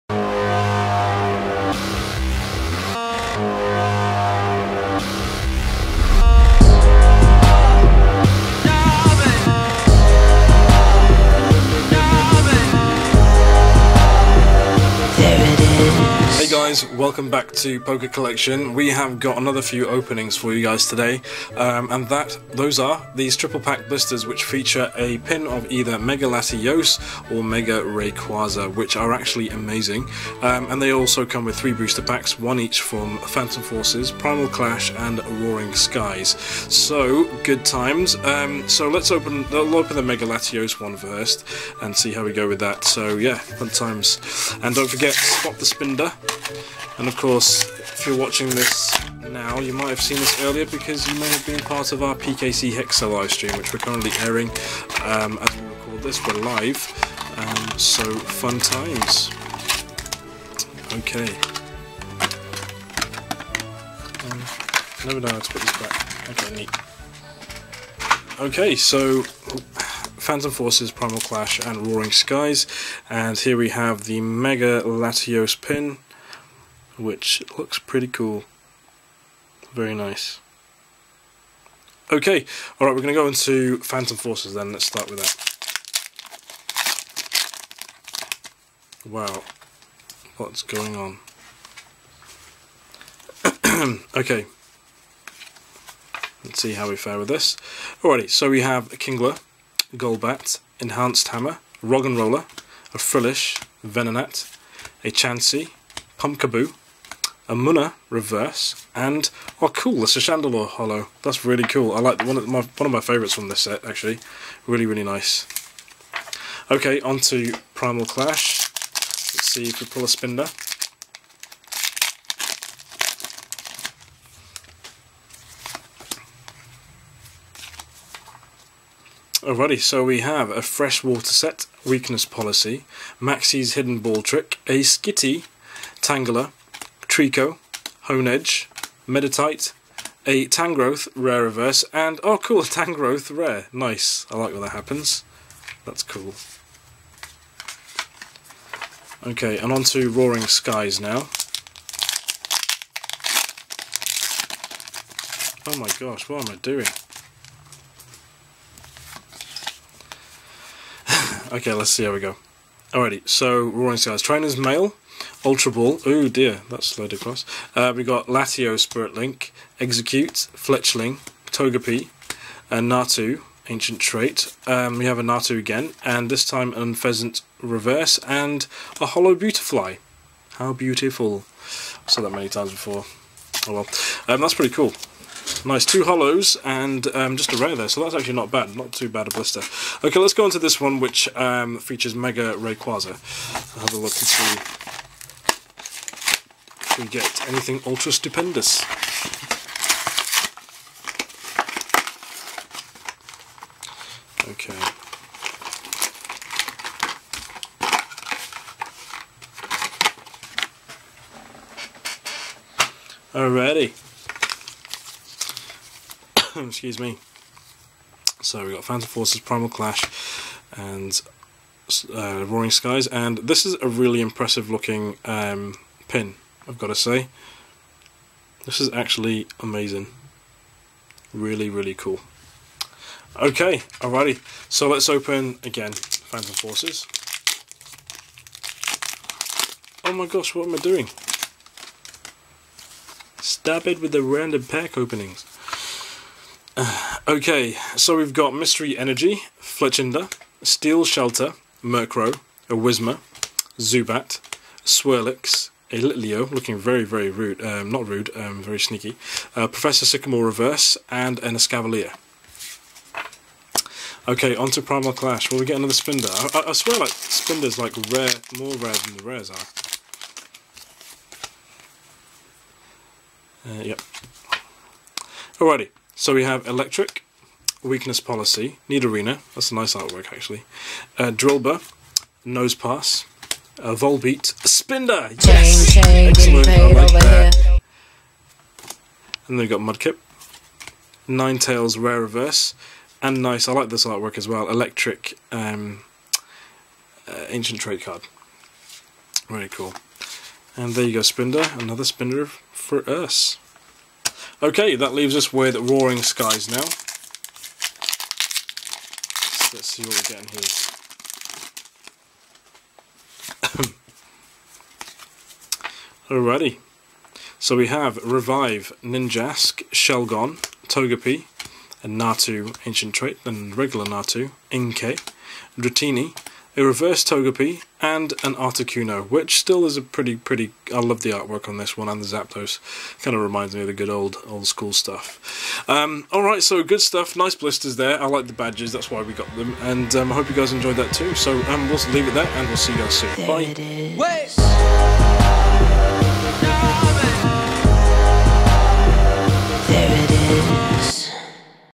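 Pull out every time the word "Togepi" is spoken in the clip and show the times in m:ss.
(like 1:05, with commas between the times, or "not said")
2:51, 5:20, 5:27.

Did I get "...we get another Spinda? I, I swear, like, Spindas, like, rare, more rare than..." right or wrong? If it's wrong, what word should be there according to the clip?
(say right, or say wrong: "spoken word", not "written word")
right.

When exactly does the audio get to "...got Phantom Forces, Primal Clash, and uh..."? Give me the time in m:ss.
3:38.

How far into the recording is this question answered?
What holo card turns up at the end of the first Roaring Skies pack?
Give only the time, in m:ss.
2:59.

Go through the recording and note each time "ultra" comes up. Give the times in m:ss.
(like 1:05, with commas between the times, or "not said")
2:45, 3:17.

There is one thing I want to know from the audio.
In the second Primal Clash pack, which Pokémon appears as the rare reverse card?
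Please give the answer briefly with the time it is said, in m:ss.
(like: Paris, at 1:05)
Ninetales, at 4:51.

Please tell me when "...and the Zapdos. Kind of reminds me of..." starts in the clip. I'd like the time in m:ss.
5:32.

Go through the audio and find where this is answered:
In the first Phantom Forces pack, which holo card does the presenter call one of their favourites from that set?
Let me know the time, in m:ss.
1:50.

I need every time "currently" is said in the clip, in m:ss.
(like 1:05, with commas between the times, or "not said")
0:53.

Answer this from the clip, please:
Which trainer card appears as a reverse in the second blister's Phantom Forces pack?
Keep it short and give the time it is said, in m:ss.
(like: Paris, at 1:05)
Professor Sycamore, at 4:19.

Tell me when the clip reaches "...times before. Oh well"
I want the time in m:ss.
3:02.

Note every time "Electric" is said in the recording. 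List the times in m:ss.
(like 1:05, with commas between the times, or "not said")
4:36, 4:54.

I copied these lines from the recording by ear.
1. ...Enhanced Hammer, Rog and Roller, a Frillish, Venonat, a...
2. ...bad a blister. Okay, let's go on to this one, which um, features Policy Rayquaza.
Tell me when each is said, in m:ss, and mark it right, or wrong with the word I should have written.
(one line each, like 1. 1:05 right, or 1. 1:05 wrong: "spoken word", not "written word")
1. 1:40 right
2. 3:09 wrong: "Mega", not "Policy".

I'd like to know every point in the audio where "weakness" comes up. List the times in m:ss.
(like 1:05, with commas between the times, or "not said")
2:11, 4:37.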